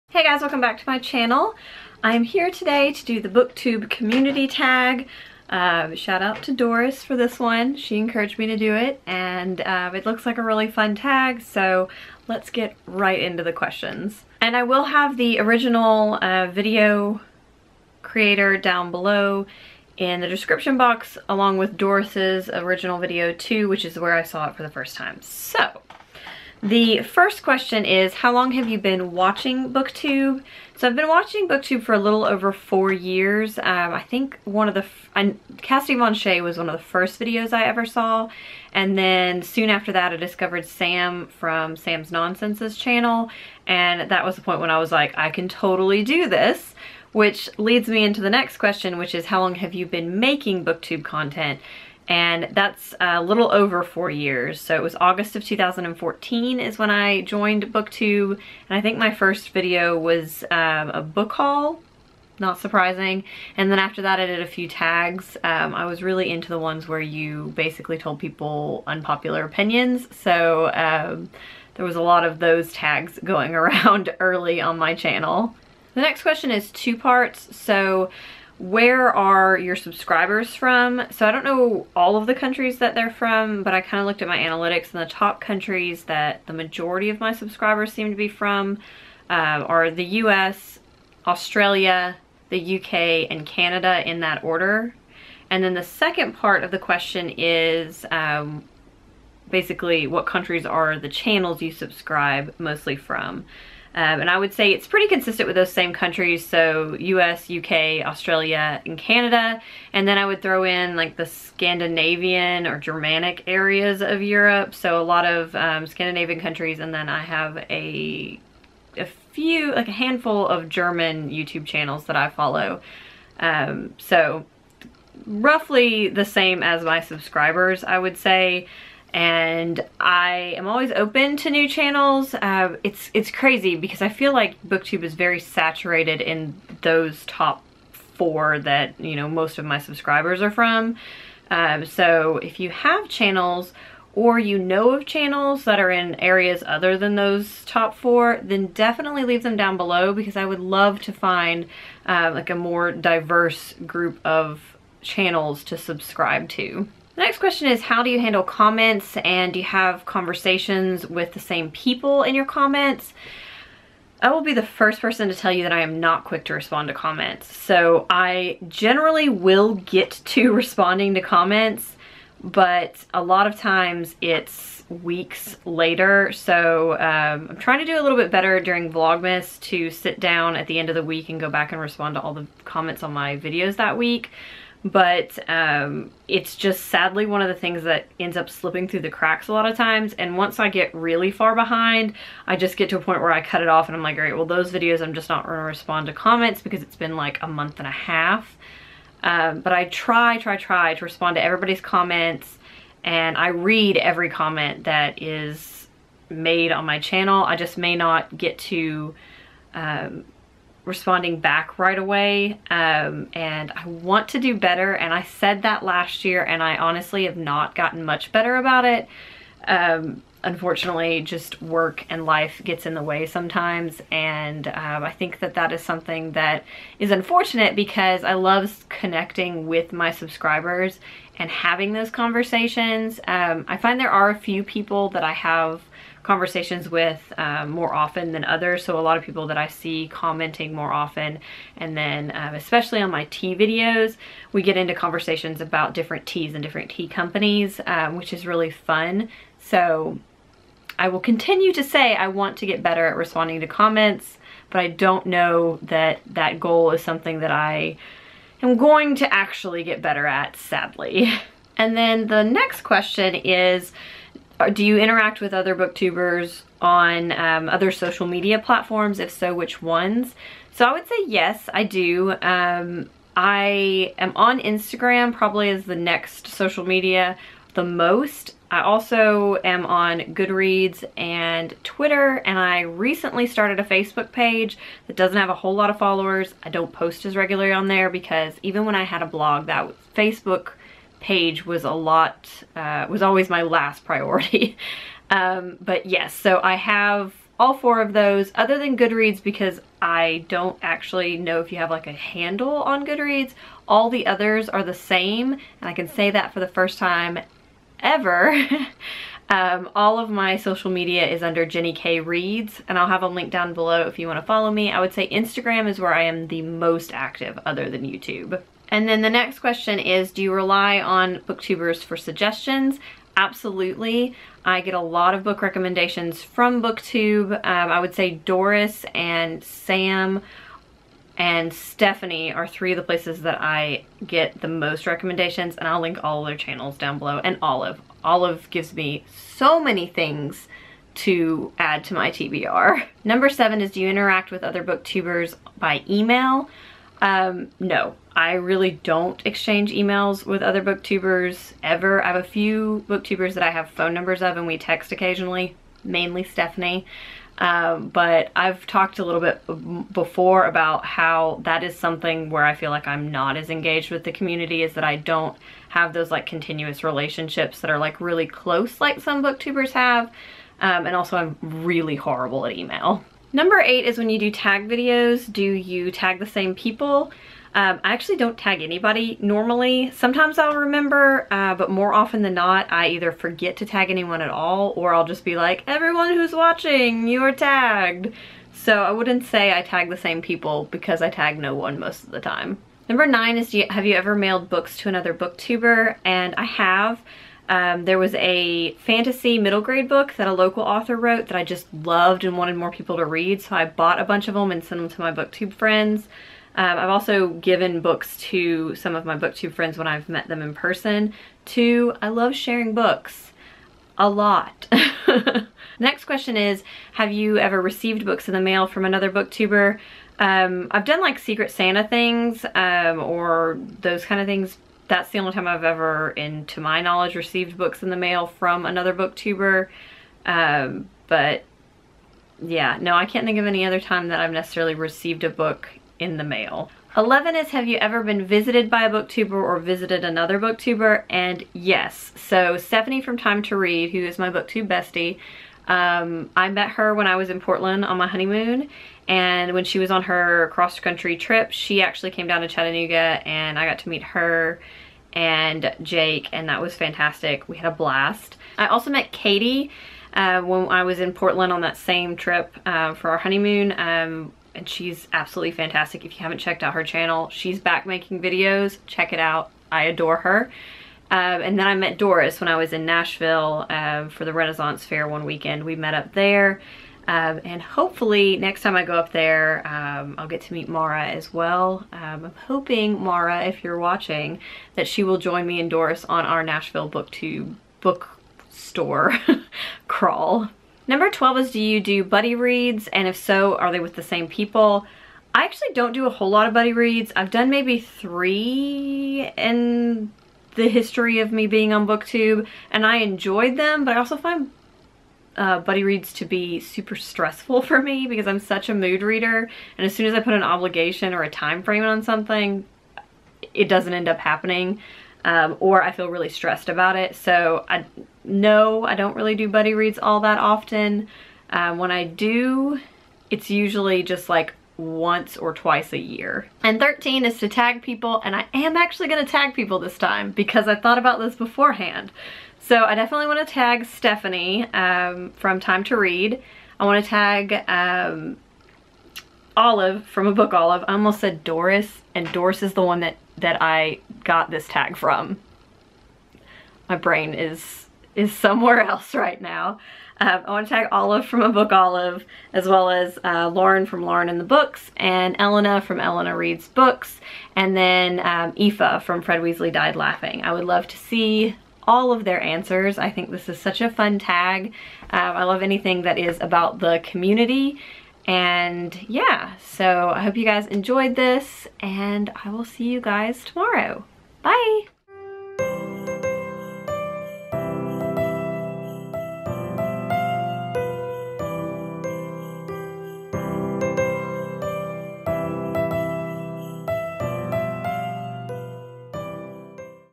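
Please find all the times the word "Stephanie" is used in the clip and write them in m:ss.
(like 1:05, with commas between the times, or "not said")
5:31, 5:56, 7:22, 8:54.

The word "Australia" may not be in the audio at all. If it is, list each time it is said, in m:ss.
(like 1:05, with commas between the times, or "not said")
1:31, 1:48.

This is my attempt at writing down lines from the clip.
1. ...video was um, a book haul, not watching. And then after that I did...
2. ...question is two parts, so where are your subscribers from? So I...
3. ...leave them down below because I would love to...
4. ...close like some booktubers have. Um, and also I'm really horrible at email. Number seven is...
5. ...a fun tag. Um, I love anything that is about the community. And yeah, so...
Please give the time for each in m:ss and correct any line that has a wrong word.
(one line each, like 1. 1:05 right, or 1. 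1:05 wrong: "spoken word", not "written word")
1. 0:59 wrong: "surprising", not "watching"
2. 1:16 right
3. 2:29 right
4. 6:08 wrong: "eight", not "seven"
5. 9:24 right.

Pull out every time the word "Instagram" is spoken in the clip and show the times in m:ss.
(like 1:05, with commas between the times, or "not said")
4:34, 5:15.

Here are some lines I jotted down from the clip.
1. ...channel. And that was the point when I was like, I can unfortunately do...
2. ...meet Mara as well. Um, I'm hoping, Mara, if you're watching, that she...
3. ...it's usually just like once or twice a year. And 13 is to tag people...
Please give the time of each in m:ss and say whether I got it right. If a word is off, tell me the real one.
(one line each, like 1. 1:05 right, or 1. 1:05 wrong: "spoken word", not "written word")
1. 0:42 wrong: "totally", not "unfortunately"
2. 8:00 right
3. 8:43 right.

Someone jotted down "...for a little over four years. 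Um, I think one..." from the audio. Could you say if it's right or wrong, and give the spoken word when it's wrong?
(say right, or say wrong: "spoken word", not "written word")
right.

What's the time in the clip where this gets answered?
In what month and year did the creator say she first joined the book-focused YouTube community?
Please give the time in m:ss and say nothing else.
0:54.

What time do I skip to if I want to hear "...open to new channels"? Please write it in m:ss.
2:10.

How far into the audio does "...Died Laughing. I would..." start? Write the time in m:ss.
9:19.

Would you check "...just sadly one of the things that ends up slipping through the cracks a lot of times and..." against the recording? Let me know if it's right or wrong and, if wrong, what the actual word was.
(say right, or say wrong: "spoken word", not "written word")
right.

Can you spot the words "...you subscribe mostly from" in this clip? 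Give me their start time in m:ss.
1:41.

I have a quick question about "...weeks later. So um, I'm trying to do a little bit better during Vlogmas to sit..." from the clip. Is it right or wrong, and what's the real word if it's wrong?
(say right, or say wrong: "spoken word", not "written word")
right.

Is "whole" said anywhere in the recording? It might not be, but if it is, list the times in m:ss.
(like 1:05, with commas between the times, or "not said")
4:45, 8:16.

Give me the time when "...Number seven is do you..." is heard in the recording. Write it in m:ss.
5:43.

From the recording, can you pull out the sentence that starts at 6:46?
Um, I've also given books to some of my booktube friends when I've met them in person.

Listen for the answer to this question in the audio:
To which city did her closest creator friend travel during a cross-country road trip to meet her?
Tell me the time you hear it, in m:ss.
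7:32.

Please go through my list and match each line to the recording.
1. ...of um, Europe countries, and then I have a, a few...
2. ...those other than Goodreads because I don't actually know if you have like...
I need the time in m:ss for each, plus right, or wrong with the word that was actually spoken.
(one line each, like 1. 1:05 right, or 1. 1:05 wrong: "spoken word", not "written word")
1. 1:55 wrong: "Scandinavian", not "Europe"
2. 4:58 right.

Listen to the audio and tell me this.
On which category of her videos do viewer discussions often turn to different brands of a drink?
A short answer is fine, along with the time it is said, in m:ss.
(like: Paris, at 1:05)
tea videos, at 4:03.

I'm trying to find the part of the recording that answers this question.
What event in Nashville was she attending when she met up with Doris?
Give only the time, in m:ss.
7:54.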